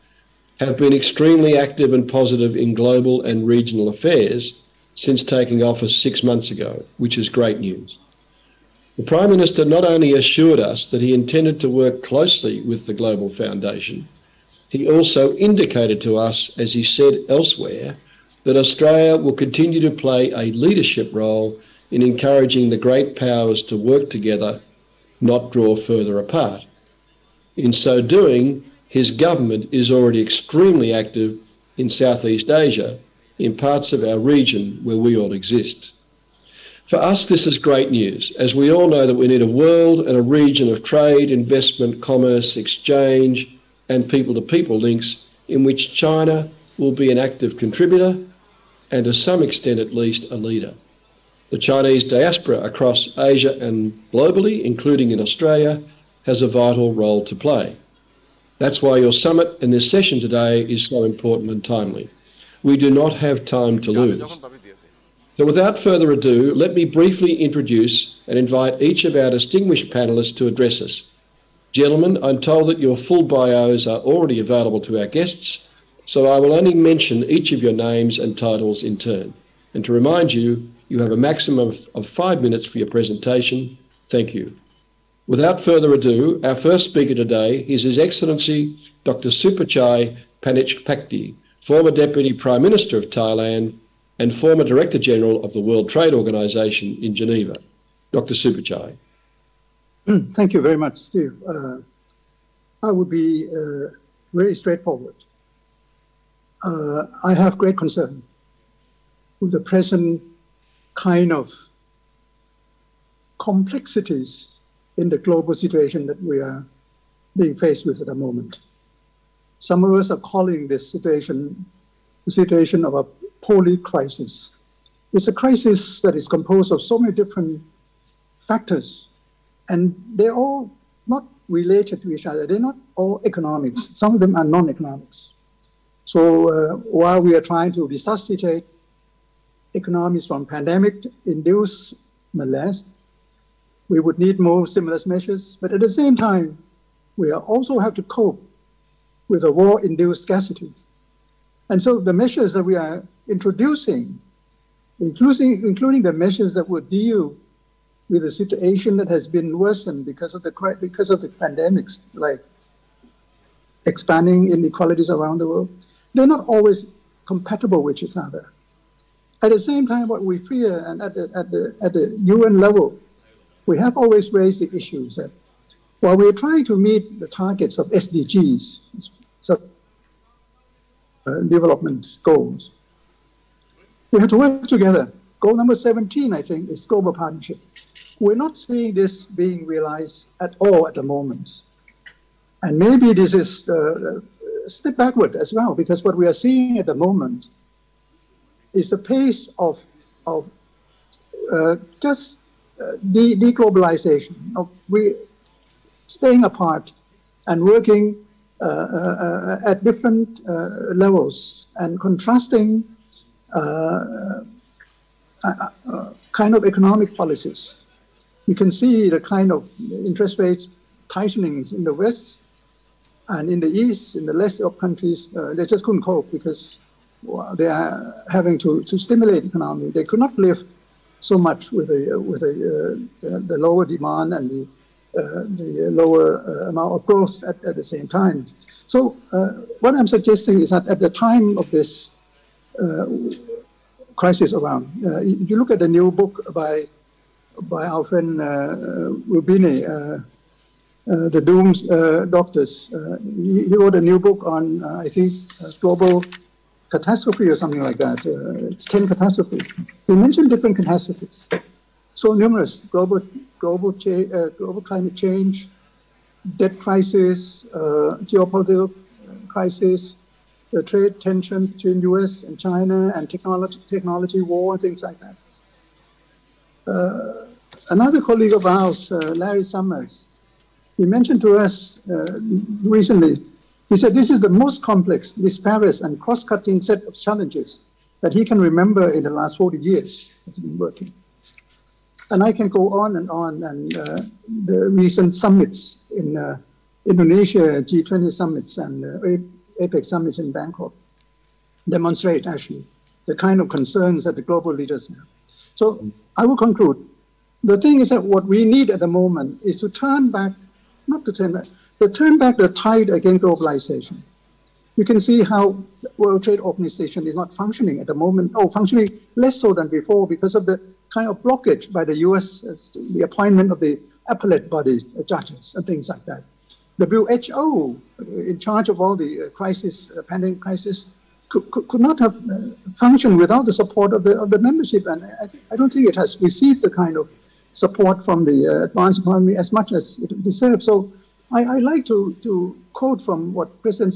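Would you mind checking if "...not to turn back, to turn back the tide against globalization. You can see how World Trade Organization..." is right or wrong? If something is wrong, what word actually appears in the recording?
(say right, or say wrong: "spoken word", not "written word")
right.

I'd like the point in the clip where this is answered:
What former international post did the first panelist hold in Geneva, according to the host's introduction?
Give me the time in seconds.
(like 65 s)
94 s.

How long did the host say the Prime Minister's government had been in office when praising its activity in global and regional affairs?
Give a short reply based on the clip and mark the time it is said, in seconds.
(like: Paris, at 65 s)
6 months, at 6 s.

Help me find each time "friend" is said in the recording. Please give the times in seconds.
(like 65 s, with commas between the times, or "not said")
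248 s.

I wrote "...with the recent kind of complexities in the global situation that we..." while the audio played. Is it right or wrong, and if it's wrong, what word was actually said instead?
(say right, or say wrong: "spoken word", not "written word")
wrong: "present", not "recent".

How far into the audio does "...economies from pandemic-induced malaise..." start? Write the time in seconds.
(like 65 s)
139 s.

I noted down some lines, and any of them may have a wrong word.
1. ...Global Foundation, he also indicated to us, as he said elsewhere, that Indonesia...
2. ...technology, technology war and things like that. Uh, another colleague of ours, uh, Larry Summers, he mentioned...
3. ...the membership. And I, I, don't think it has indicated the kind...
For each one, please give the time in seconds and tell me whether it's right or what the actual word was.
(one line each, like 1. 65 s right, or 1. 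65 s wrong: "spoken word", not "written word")
1. 12 s wrong: "Australia", not "Indonesia"
2. 273 s right
3. 334 s wrong: "received", not "indicated".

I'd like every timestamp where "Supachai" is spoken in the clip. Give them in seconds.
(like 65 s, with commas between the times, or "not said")
89 s, 98 s.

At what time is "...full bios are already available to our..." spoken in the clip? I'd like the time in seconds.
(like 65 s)
72 s.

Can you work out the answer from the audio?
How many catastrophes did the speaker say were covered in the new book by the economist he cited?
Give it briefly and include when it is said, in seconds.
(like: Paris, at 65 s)
10, at 258 s.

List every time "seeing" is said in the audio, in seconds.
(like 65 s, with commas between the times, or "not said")
188 s, 196 s.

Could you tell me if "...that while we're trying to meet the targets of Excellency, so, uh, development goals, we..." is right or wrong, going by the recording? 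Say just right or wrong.
wrong.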